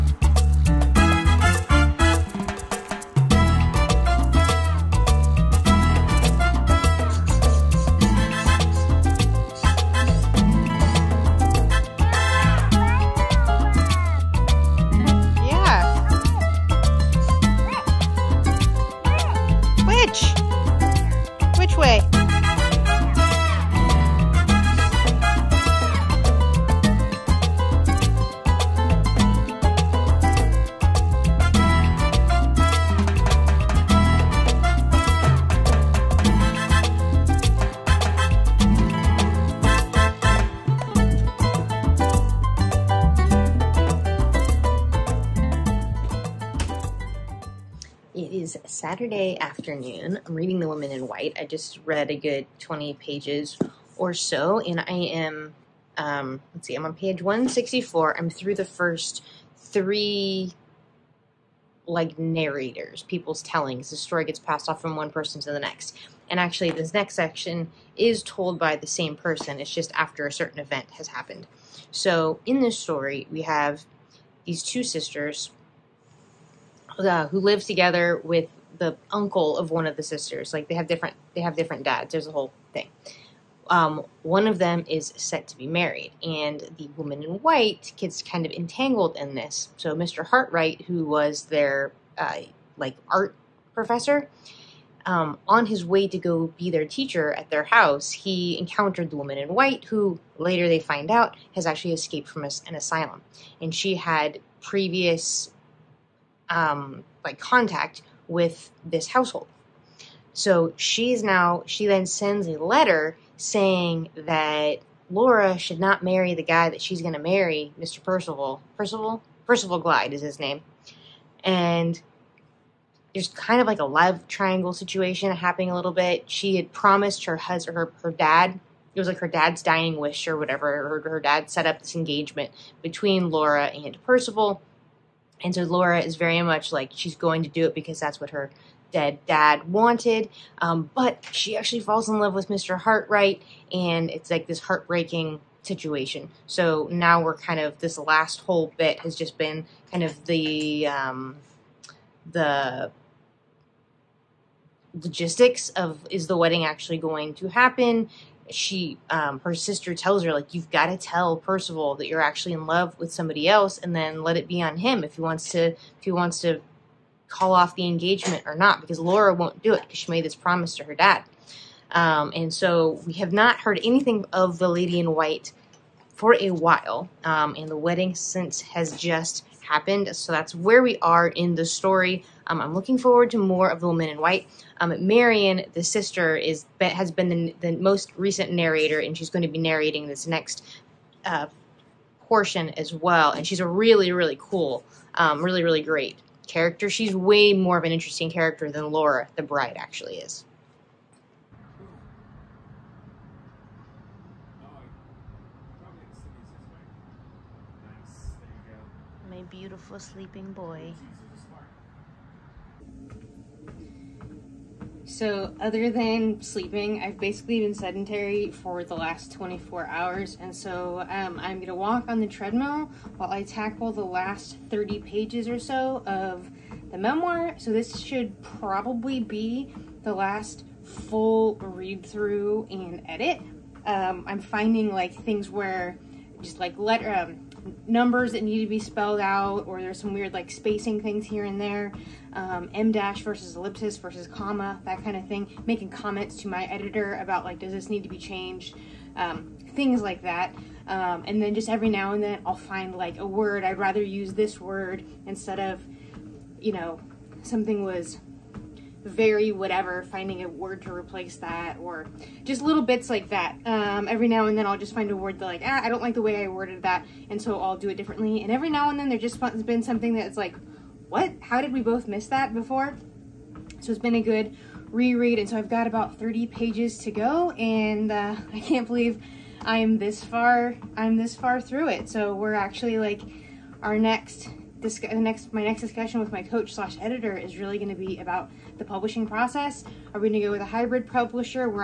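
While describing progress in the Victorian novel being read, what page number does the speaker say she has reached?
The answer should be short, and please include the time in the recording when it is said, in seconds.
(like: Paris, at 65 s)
164, at 57 s.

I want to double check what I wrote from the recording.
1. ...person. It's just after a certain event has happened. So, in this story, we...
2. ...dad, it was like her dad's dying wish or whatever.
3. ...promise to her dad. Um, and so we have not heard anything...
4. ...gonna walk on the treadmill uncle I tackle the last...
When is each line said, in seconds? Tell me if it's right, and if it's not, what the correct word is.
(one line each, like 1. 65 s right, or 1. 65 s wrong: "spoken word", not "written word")
1. 69 s right
2. 128 s right
3. 170 s right
4. 221 s wrong: "while", not "uncle".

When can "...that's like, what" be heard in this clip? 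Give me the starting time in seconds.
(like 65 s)
270 s.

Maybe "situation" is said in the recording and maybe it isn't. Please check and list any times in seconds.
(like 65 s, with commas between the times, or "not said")
124 s, 145 s.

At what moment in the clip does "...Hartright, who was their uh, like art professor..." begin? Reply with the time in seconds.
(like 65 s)
90 s.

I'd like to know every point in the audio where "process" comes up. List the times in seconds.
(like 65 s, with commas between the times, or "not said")
289 s.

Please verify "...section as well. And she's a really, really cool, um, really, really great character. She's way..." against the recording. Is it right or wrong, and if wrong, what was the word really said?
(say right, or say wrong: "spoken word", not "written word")
wrong: "portion", not "section".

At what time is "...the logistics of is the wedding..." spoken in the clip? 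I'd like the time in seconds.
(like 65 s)
152 s.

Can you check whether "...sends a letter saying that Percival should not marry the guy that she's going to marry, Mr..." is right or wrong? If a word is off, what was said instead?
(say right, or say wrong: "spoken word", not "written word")
wrong: "Laura", not "Percival".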